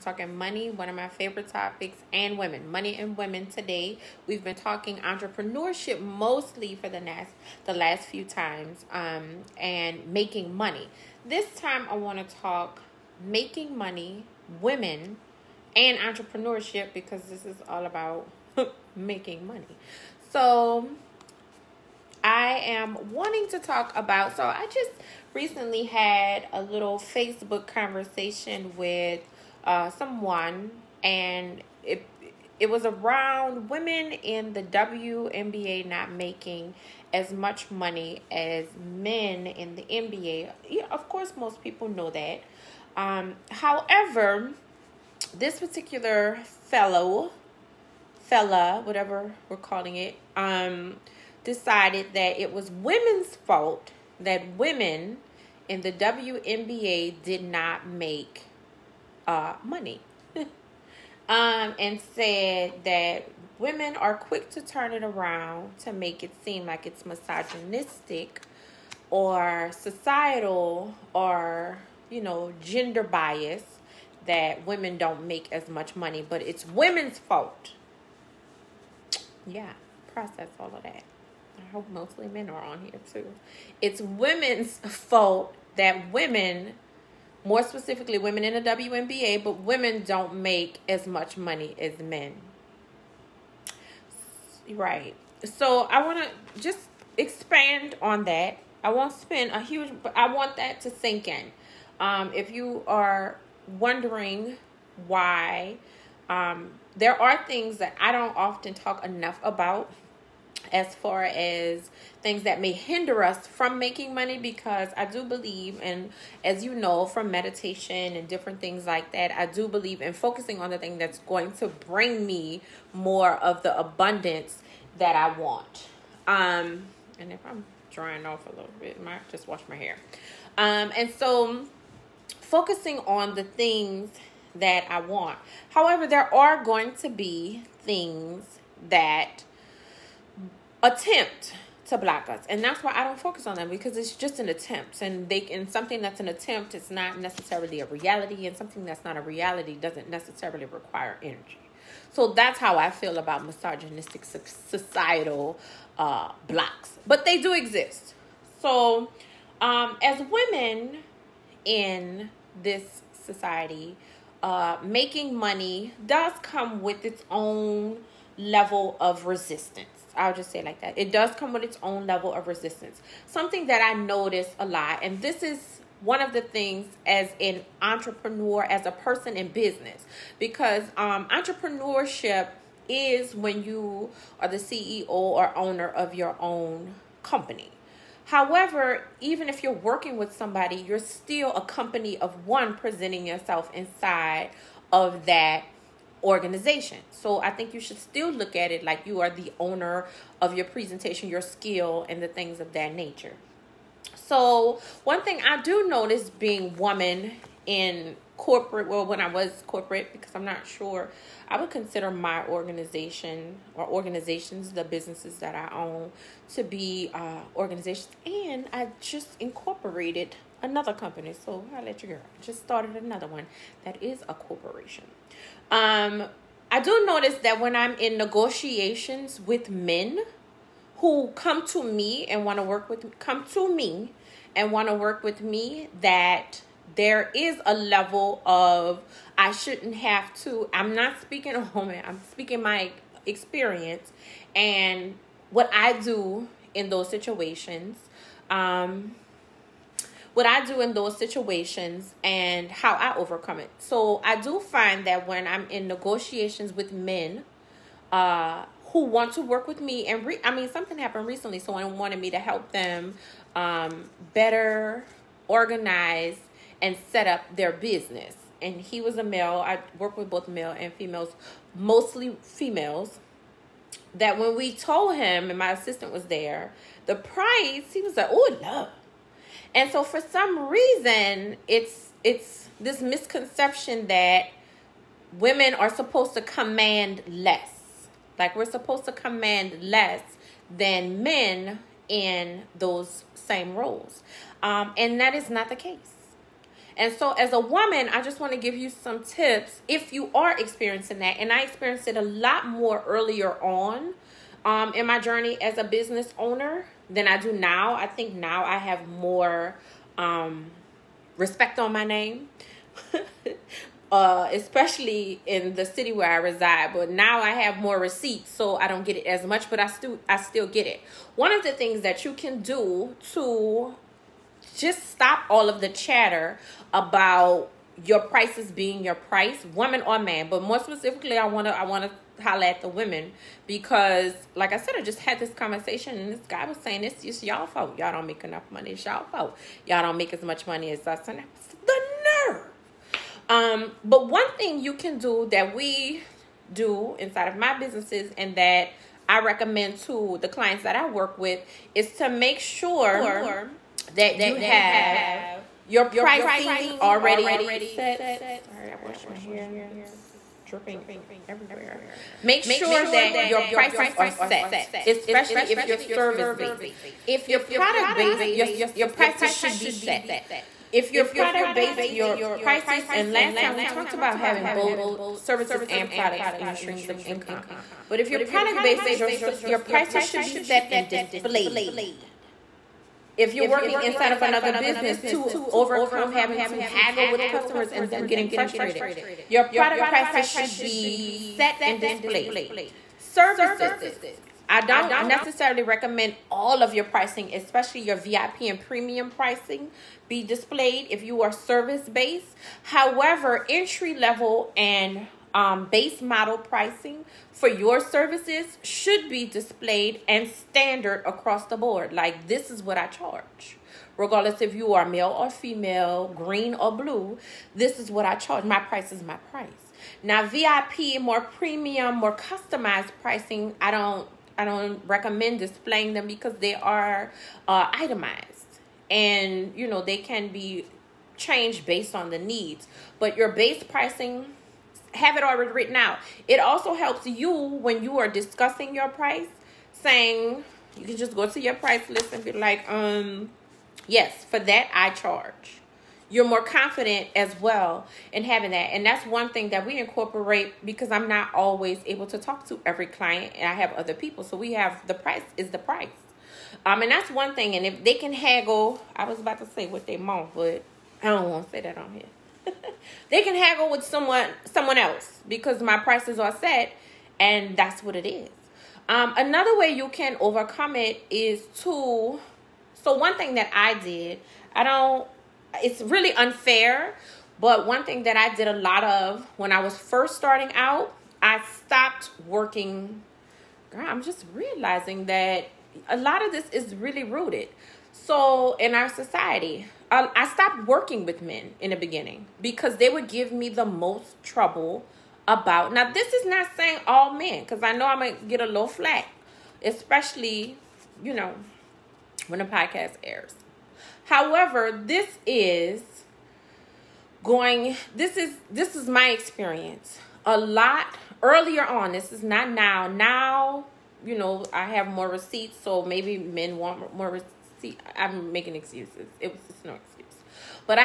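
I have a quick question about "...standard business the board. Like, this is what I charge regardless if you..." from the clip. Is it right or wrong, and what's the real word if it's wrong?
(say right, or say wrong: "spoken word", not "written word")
wrong: "across", not "business".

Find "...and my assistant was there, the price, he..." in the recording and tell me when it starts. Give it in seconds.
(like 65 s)
275 s.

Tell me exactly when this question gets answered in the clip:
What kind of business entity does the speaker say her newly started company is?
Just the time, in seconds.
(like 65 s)
224 s.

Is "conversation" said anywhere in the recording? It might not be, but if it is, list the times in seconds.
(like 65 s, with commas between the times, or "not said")
27 s, 335 s.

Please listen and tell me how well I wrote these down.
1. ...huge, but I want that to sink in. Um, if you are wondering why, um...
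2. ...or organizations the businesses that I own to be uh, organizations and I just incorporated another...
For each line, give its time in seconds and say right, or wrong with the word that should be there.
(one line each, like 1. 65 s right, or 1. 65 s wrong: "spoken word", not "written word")
1. 99 s right
2. 213 s right.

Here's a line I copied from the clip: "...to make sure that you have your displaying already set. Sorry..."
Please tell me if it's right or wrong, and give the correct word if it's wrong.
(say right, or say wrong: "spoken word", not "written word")
wrong: "pricing", not "displaying".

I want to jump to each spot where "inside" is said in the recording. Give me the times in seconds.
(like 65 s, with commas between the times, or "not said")
193 s, 347 s, 384 s.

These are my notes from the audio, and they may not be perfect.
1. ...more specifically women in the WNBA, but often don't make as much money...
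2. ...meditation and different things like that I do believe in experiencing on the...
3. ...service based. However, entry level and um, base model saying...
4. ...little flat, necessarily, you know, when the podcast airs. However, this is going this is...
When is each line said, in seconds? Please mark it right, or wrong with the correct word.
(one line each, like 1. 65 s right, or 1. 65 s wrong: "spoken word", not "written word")
1. 87 s wrong: "women", not "often"
2. 117 s wrong: "focusing", not "experiencing"
3. 401 s wrong: "pricing", not "saying"
4. 498 s wrong: "especially", not "necessarily".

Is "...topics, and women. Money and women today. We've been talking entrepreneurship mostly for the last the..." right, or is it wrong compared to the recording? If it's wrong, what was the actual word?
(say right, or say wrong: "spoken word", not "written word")
right.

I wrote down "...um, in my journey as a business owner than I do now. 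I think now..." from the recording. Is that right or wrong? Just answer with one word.
right.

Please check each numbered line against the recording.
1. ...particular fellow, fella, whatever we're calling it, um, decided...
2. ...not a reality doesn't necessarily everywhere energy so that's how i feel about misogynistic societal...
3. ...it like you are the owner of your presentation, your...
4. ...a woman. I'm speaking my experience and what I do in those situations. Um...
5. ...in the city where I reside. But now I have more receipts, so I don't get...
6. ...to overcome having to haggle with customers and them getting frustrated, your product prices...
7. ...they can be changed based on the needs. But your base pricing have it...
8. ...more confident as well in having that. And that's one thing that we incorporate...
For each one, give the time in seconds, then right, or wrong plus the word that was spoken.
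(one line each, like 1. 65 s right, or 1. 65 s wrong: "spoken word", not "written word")
1. 45 s right
2. 149 s wrong: "require", not "everywhere"
3. 198 s right
4. 241 s right
5. 315 s right
6. 385 s right
7. 430 s right
8. 446 s right.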